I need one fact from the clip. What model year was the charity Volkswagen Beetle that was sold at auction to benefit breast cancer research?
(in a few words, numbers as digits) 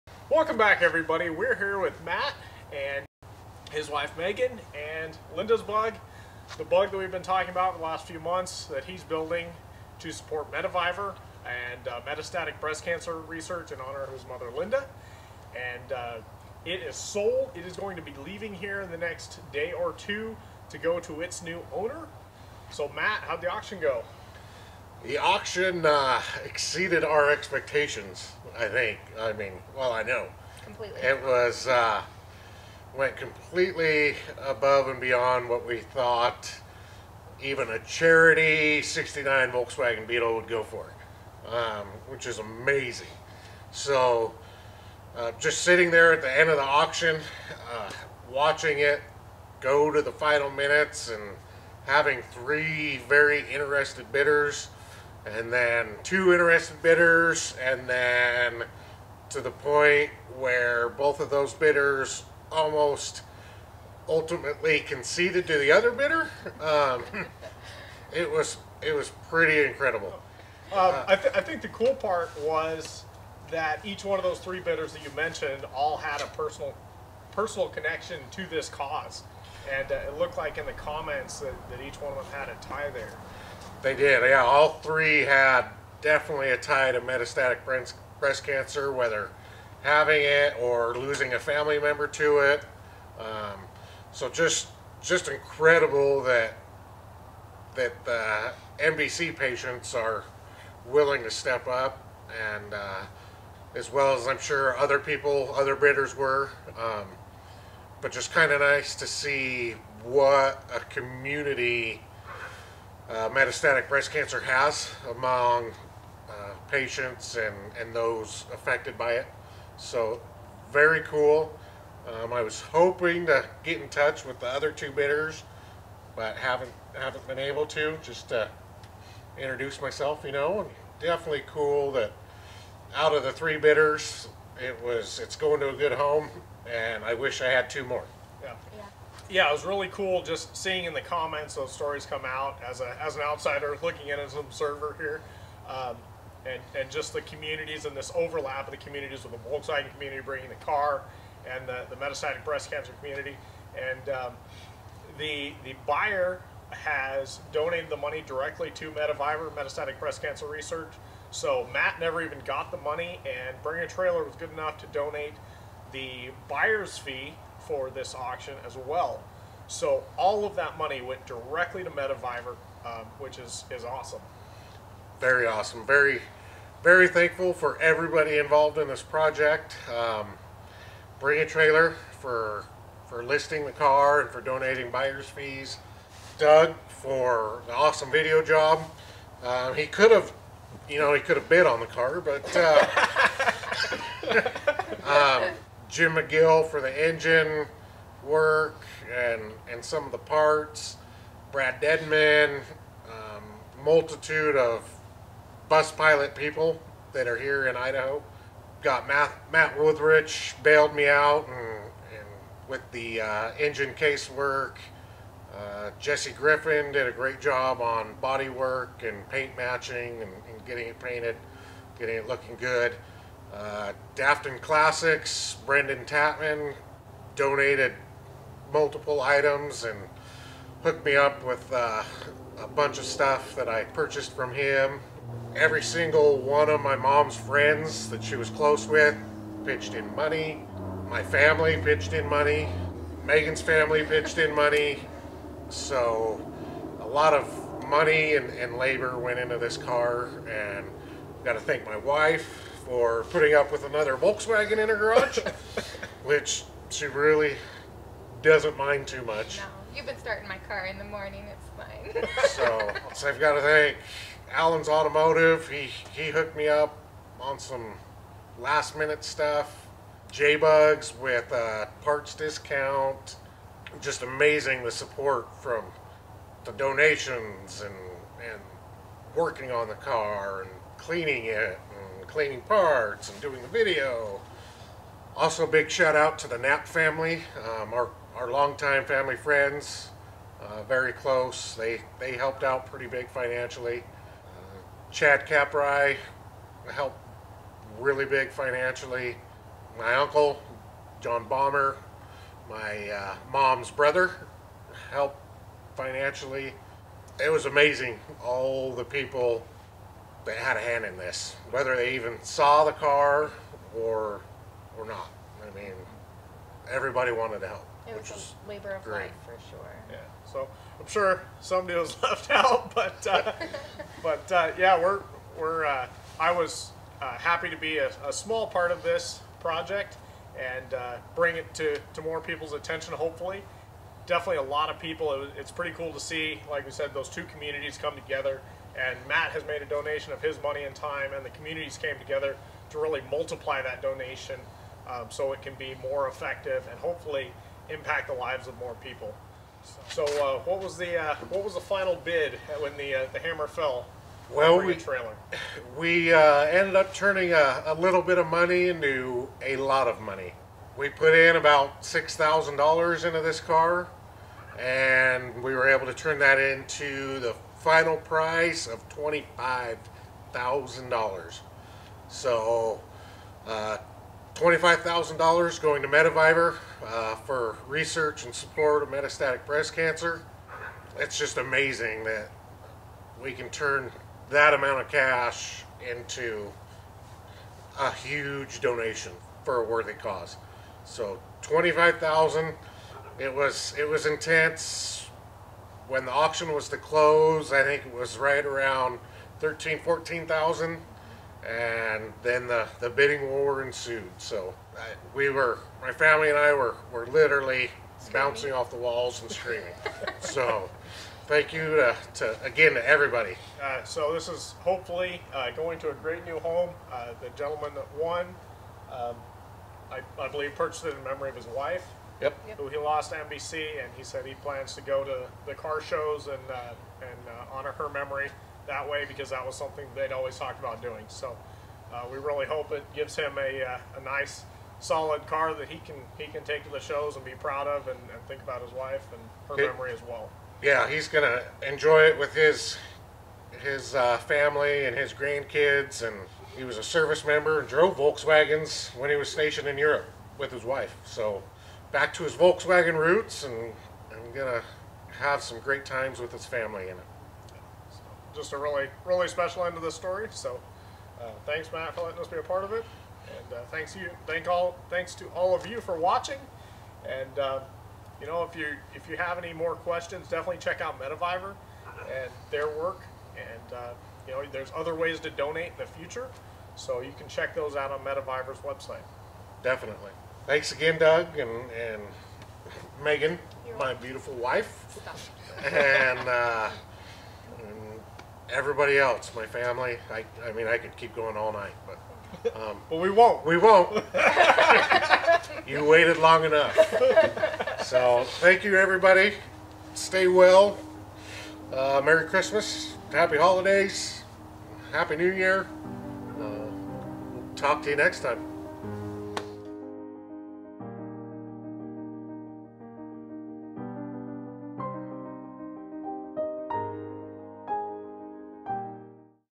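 1969.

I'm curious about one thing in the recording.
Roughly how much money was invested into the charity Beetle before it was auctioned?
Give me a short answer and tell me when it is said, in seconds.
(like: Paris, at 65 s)
$6,000, at 362 s.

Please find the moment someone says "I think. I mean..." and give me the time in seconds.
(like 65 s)
28 s.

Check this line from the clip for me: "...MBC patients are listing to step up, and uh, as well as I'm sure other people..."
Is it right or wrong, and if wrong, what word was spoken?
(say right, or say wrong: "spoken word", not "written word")
wrong: "willing", not "listing".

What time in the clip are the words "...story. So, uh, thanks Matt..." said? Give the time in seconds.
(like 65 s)
460 s.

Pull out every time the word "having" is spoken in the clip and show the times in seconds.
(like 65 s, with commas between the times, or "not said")
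51 s, 89 s.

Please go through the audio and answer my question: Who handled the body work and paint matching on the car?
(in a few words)
Jesse Griffin.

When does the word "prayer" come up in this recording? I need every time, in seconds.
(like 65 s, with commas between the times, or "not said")
not said.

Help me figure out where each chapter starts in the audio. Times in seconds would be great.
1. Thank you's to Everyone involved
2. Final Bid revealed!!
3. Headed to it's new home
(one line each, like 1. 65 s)
1. 175 s
2. 335 s
3. 413 s.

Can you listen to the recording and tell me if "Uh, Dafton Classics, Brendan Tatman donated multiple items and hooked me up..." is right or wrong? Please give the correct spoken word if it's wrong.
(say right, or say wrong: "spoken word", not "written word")
right.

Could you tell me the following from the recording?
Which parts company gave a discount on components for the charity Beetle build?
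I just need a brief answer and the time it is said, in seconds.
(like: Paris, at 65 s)
JBugs, at 270 s.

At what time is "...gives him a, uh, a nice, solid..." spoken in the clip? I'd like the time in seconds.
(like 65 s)
433 s.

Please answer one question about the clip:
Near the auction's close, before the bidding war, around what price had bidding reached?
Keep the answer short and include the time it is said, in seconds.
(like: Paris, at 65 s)
13,000 to 14,000, at 399 s.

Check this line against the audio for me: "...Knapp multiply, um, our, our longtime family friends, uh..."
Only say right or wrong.
wrong.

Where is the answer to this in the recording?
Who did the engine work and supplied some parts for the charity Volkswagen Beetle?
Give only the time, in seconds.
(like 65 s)
195 s.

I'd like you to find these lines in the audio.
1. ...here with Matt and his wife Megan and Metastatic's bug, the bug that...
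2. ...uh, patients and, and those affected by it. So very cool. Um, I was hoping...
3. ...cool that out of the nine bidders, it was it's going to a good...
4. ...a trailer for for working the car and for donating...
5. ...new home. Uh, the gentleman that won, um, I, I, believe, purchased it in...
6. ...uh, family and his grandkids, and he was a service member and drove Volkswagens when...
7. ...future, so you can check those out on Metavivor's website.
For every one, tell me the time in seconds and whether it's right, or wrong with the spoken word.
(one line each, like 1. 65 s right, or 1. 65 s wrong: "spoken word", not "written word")
1. 1 s wrong: "Linda", not "Metastatic"
2. 116 s right
3. 131 s wrong: "three", not "nine"
4. 181 s wrong: "listing", not "working"
5. 416 s right
6. 444 s right
7. 476 s right.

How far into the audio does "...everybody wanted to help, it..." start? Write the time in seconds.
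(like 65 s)
316 s.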